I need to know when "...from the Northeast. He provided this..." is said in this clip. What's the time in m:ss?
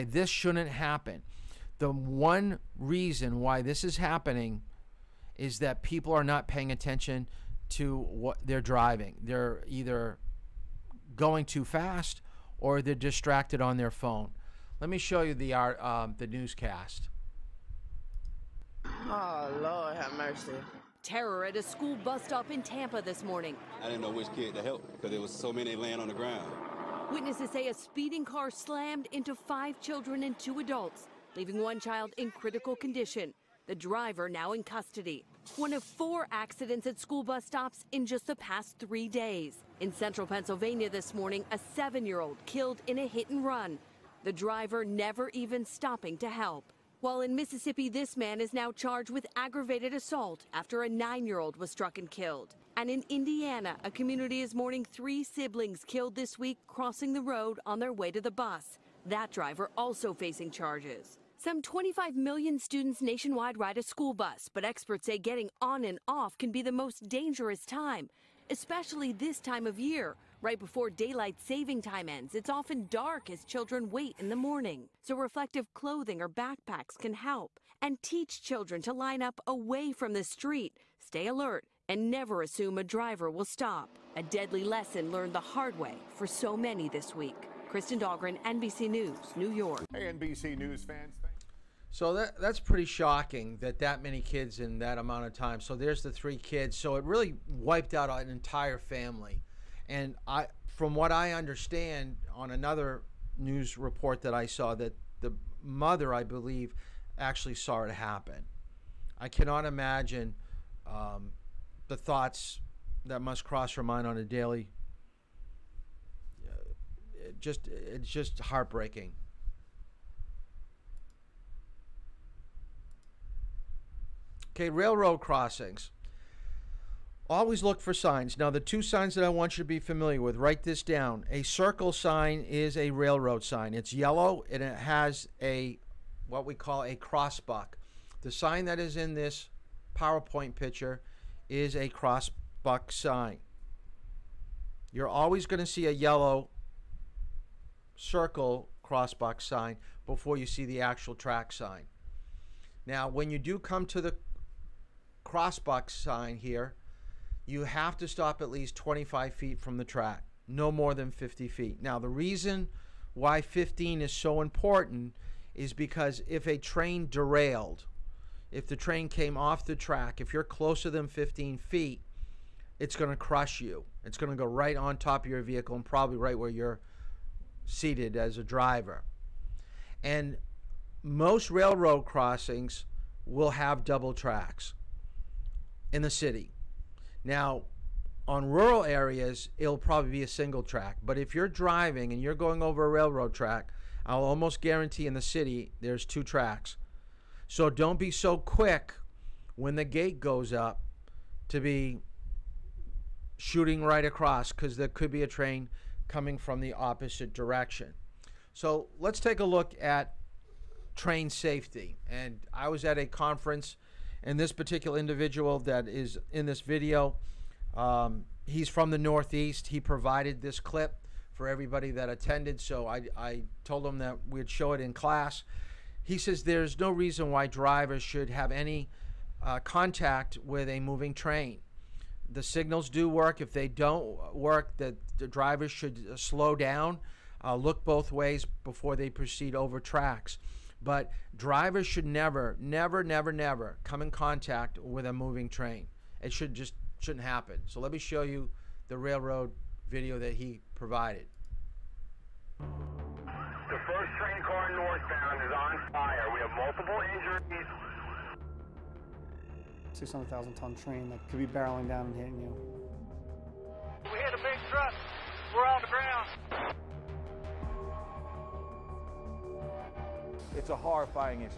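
3:38.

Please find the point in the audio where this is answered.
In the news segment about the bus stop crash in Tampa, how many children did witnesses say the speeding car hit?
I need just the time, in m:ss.
0:29.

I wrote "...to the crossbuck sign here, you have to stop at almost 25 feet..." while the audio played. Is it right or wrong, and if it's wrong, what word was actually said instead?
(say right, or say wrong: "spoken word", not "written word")
wrong: "least", not "almost".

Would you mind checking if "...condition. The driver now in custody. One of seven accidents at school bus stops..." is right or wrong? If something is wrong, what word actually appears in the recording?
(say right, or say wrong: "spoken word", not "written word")
wrong: "four", not "seven".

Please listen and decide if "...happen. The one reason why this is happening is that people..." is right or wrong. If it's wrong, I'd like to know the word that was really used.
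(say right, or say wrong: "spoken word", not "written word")
right.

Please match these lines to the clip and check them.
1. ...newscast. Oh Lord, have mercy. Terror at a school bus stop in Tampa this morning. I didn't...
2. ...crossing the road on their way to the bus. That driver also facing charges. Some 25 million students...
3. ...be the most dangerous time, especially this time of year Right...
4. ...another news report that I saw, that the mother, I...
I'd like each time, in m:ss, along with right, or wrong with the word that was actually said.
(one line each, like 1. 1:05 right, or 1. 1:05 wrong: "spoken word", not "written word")
1. 0:16 right
2. 0:56 right
3. 1:06 right
4. 1:42 right.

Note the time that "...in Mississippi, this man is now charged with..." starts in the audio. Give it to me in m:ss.
0:47.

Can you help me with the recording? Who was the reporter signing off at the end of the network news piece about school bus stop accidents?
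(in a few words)
Kristen Dahlgren.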